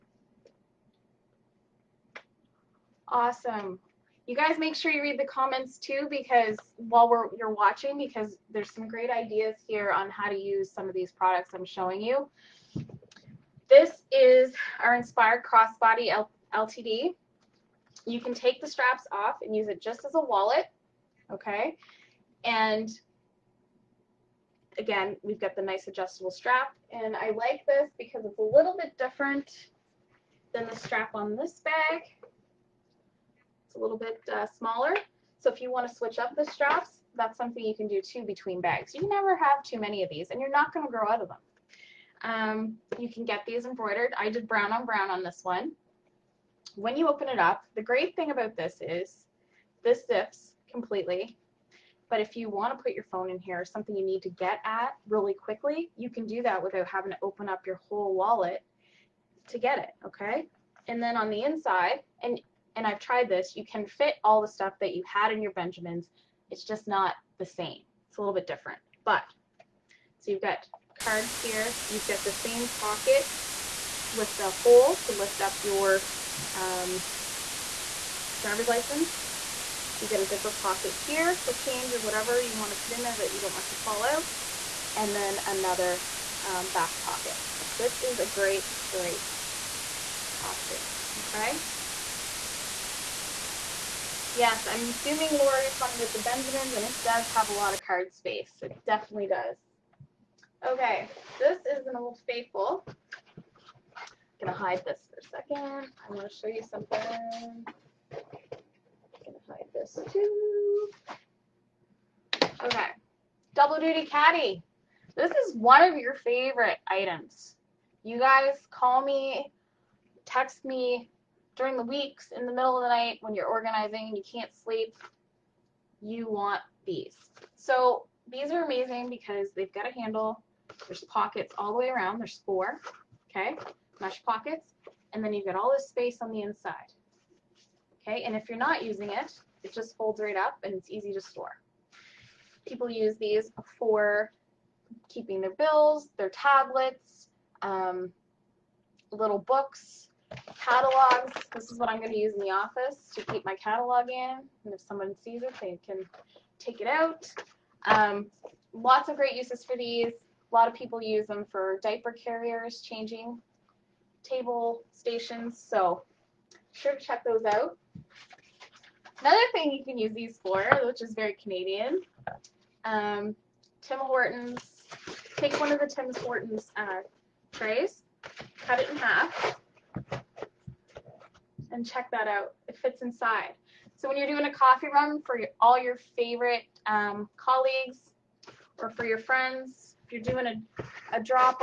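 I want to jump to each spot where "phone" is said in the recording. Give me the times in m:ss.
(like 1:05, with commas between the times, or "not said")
0:53.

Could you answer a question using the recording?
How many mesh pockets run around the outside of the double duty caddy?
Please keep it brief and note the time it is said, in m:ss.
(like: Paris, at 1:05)
4, at 2:12.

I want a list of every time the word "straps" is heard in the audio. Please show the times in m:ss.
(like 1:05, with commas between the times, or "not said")
0:18, 0:26, 0:30, 0:36.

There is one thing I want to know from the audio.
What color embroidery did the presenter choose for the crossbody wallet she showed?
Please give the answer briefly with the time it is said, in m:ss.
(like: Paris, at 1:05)
brown on brown, at 0:44.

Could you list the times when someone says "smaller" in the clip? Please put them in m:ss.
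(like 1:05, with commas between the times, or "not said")
0:34.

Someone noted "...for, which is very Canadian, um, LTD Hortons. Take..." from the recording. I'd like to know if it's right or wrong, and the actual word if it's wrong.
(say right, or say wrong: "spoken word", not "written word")
wrong: "Tim", not "LTD".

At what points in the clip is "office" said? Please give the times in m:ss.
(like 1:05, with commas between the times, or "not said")
2:32.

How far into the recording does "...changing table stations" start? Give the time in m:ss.
2:42.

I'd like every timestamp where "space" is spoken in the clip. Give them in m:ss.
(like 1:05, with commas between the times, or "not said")
1:38, 2:15.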